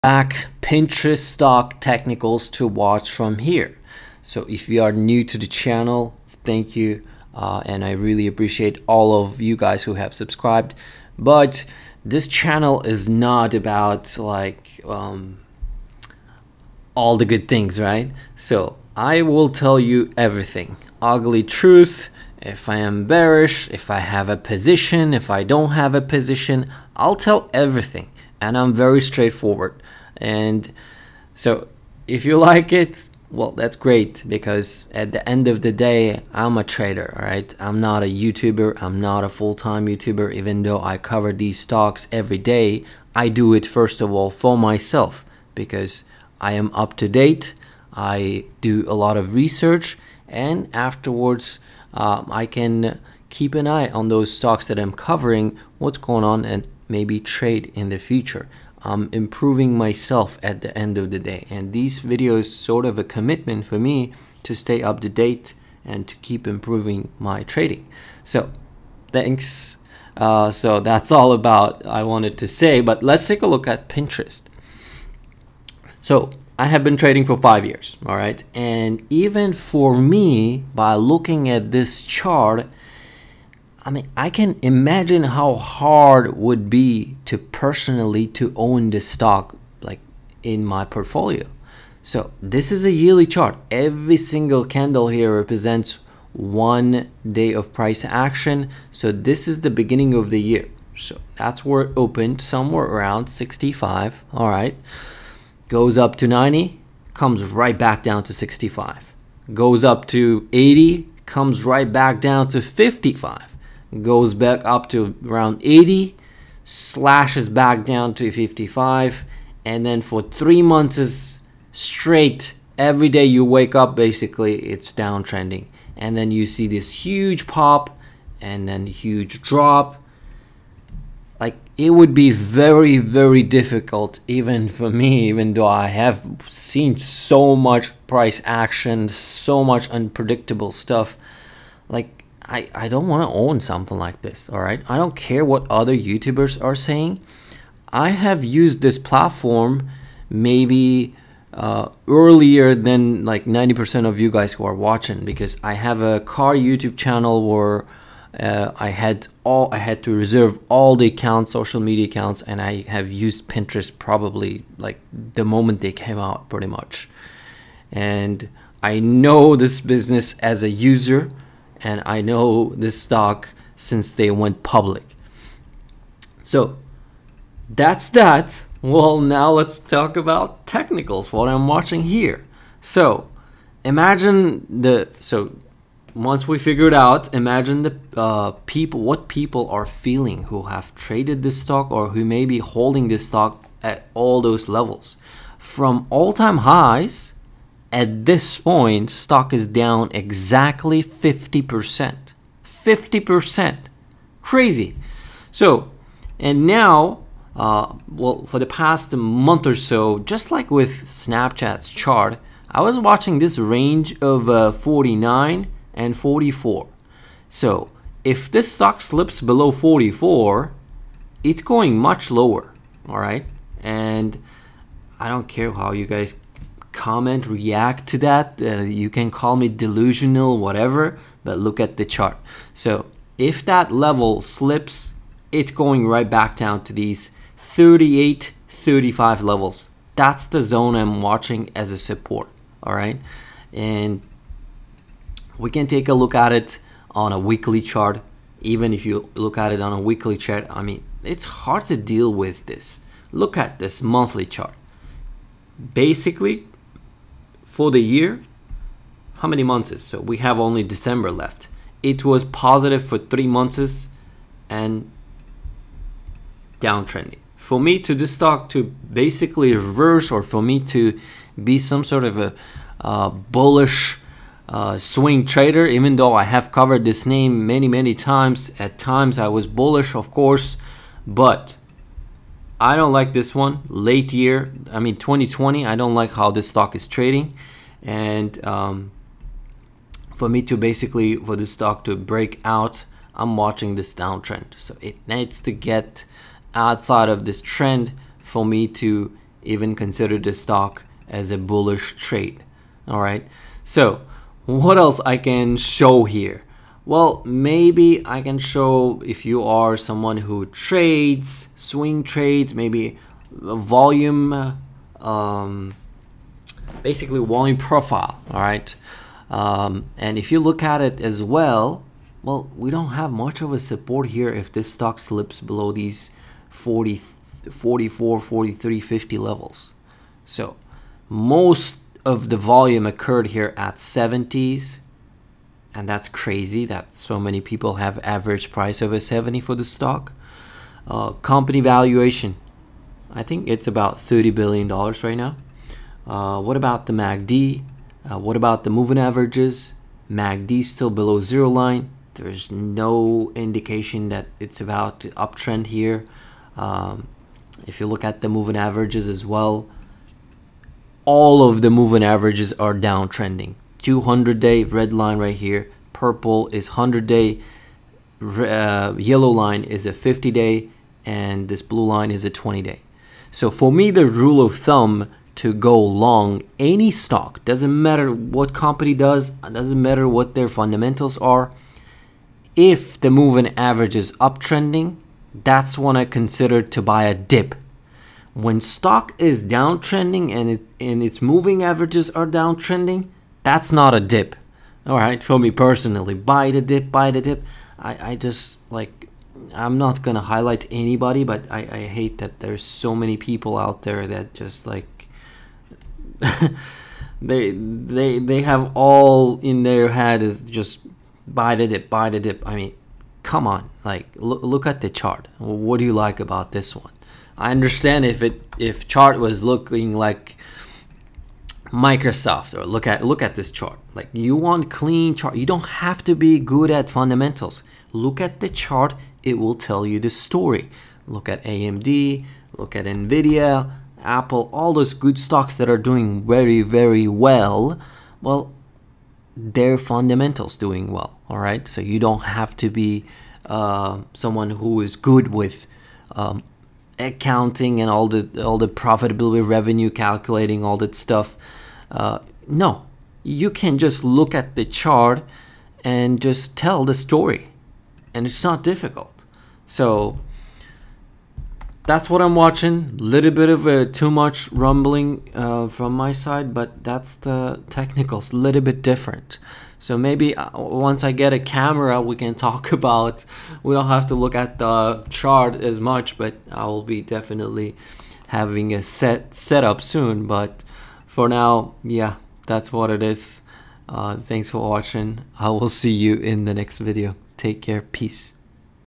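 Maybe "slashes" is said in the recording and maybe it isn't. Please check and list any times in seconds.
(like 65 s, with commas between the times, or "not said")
116 s.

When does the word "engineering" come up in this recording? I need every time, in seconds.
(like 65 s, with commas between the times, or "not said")
not said.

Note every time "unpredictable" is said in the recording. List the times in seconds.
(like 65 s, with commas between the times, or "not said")
139 s.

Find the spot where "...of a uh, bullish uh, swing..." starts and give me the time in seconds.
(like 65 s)
272 s.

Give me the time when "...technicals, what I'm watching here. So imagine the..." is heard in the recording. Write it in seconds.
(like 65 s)
180 s.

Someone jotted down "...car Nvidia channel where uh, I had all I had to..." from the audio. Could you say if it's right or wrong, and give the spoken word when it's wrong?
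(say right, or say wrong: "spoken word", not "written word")
wrong: "YouTube", not "Nvidia".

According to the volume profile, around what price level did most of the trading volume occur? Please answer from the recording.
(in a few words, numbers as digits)
70s.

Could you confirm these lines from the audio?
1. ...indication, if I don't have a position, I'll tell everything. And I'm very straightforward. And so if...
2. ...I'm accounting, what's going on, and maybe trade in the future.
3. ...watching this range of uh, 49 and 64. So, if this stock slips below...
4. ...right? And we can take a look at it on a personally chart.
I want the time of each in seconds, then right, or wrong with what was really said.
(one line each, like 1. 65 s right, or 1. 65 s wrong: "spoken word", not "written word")
1. 24 s wrong: "position", not "indication"
2. 54 s wrong: "covering", not "accounting"
3. 212 s wrong: "44", not "64"
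4. 242 s wrong: "weekly", not "personally".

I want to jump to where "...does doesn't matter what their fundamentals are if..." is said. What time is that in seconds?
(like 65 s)
379 s.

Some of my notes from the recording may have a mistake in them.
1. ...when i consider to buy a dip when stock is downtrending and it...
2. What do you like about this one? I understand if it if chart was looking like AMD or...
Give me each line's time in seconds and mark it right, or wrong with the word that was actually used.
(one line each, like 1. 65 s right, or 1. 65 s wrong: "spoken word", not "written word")
1. 385 s right
2. 415 s wrong: "Microsoft", not "AMD".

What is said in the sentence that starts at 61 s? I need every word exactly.
And these videos sort of a commitment for me to stay up to date and to keep improving my trading.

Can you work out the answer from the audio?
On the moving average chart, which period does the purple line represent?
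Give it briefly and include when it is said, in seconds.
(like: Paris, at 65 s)
100 day, at 366 s.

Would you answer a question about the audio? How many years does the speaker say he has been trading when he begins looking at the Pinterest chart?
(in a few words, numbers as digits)
5.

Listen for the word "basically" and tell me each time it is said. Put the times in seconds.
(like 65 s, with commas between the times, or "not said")
123 s, 255 s, 269 s, 290 s, 317 s.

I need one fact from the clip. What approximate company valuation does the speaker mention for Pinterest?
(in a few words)
$30 billion.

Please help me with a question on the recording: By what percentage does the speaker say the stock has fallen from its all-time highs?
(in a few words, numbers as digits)
50%.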